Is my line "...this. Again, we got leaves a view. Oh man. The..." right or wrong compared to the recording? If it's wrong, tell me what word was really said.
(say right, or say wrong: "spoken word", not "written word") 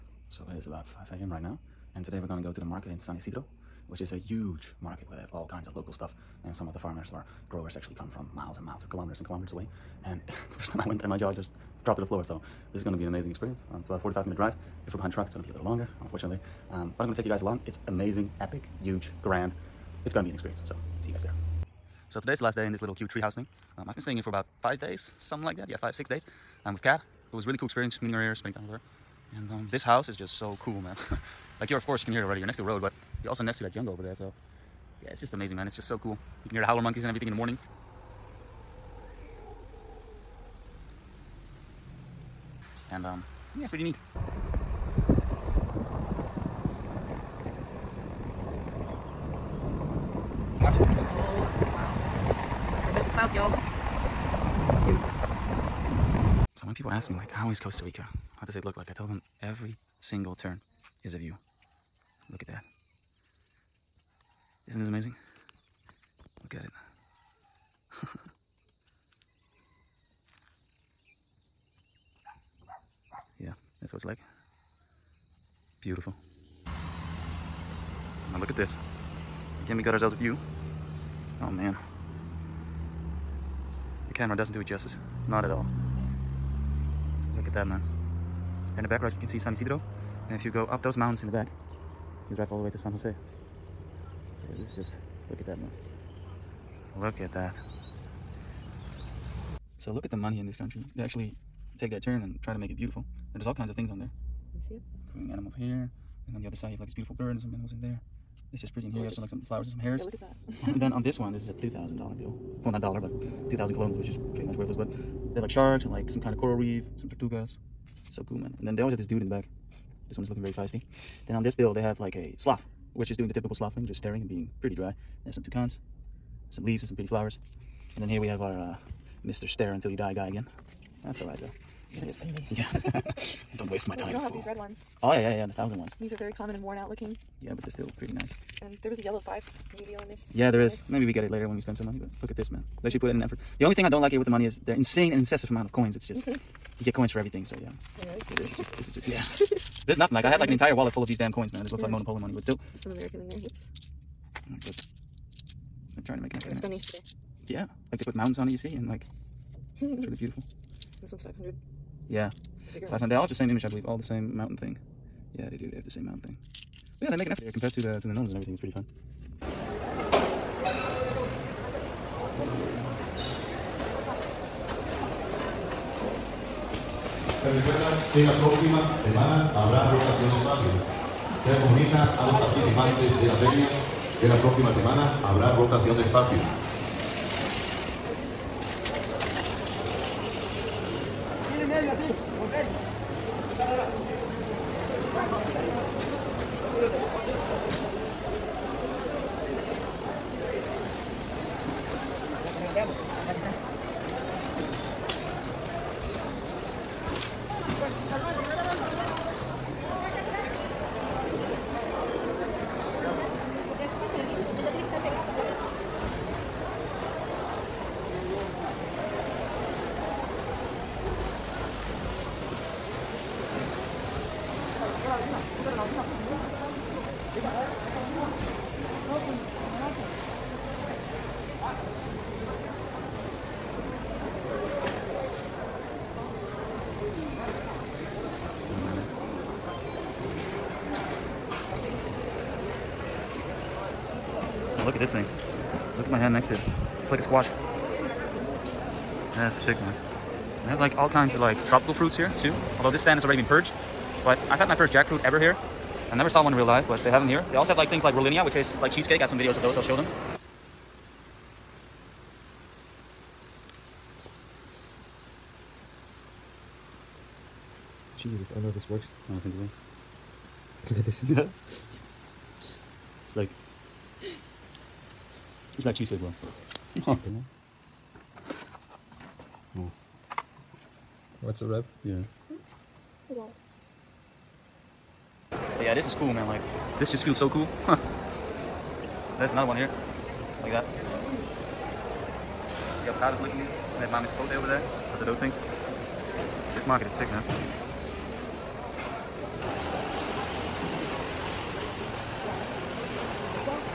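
wrong: "ourselves", not "leaves".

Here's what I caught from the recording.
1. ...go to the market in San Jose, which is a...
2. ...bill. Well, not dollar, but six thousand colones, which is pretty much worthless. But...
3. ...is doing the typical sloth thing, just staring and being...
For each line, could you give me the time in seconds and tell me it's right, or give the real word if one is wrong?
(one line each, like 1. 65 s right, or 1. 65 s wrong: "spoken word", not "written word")
1. 2 s wrong: "Isidro", not "Jose"
2. 112 s wrong: "two", not "six"
3. 123 s right.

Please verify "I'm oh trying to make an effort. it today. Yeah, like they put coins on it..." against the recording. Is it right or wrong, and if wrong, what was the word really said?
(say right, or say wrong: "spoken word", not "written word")
wrong: "mountains", not "coins".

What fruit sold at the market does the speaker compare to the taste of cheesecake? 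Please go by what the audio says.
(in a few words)
Rollinia.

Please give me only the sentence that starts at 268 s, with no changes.
Jesus, I don't know if this works.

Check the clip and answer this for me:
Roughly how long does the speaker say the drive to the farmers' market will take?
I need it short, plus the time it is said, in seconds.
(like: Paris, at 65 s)
45 minutes, at 14 s.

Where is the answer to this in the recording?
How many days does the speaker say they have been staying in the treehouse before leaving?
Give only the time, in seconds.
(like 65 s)
24 s.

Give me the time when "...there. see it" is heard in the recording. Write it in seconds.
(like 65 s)
103 s.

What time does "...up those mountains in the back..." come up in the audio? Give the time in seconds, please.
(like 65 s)
90 s.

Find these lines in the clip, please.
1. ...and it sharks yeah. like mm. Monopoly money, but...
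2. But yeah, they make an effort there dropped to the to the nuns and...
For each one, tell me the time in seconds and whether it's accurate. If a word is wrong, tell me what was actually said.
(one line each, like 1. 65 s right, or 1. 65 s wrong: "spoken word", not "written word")
1. 151 s wrong: "looks", not "sharks"
2. 167 s wrong: "compared", not "dropped".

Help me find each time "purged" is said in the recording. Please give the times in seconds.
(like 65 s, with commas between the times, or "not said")
253 s.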